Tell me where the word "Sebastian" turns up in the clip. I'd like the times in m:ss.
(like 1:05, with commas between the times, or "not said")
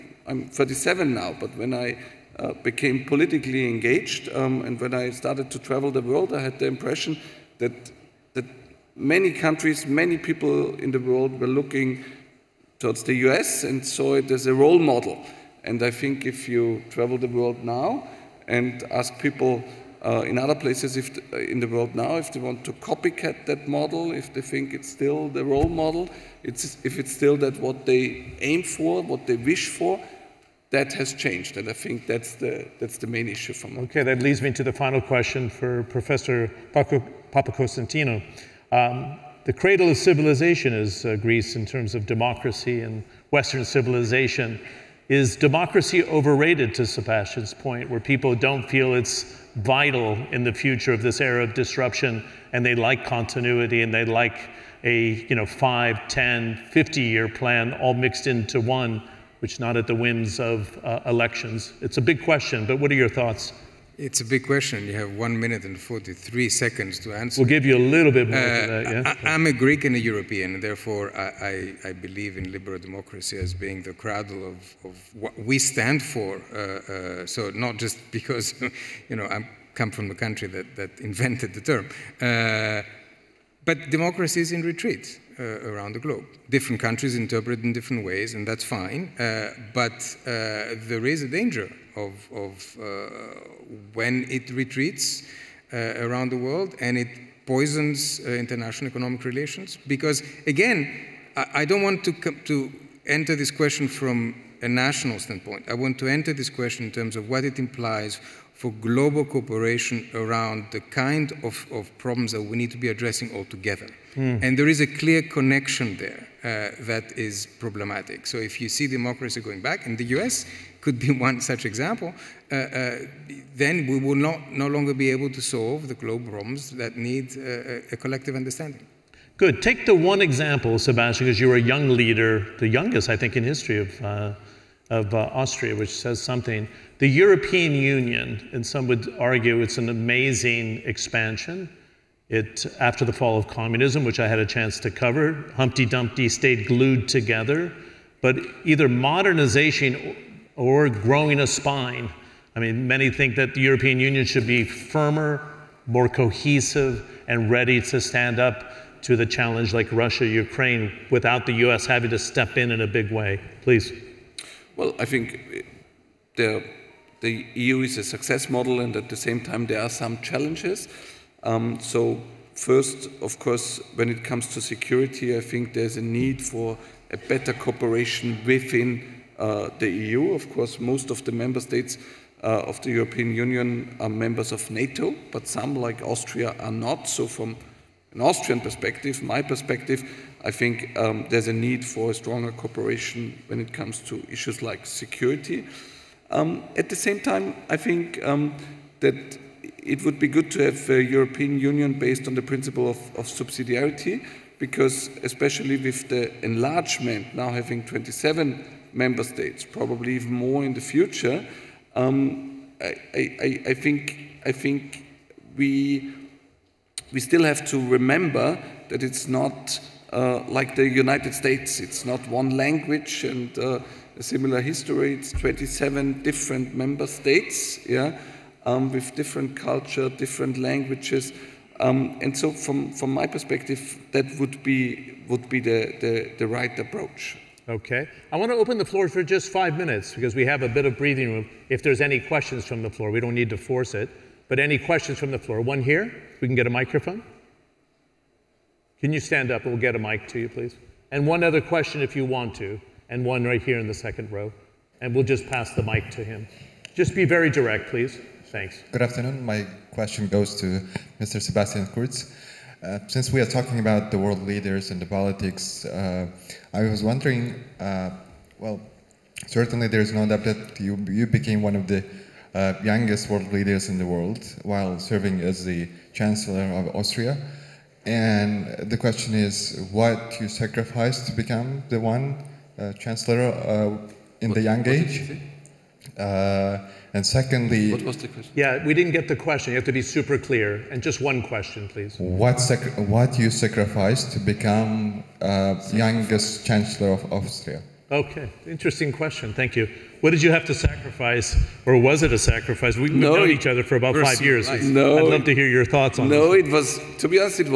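0:46, 2:10, 4:21.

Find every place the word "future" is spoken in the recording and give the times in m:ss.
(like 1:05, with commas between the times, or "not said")
0:50, 3:30.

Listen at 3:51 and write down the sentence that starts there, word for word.
Um, and so from, from my perspective, that would be, would be the, the, the right approach.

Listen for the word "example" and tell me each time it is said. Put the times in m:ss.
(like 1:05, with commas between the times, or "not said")
2:01, 2:10.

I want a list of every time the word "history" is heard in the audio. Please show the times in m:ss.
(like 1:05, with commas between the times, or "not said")
2:13, 3:44.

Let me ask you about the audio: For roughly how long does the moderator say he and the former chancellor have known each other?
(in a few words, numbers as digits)
About five years.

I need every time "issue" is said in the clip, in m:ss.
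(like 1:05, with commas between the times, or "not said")
0:33, 3:14.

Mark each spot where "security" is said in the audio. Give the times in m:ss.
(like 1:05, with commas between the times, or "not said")
2:54, 3:14.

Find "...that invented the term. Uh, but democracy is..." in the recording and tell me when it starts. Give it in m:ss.
1:20.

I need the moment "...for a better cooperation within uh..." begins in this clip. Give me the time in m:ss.
2:56.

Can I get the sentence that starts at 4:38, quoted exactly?
And the question is, what you sacrificed to become the one uh, Chancellor in what, the young age?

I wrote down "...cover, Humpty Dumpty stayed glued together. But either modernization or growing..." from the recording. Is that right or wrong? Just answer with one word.
right.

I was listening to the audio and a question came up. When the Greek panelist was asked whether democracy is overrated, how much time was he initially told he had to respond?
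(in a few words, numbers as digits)
1 minute 43 seconds.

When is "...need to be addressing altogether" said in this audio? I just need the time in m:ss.
1:52.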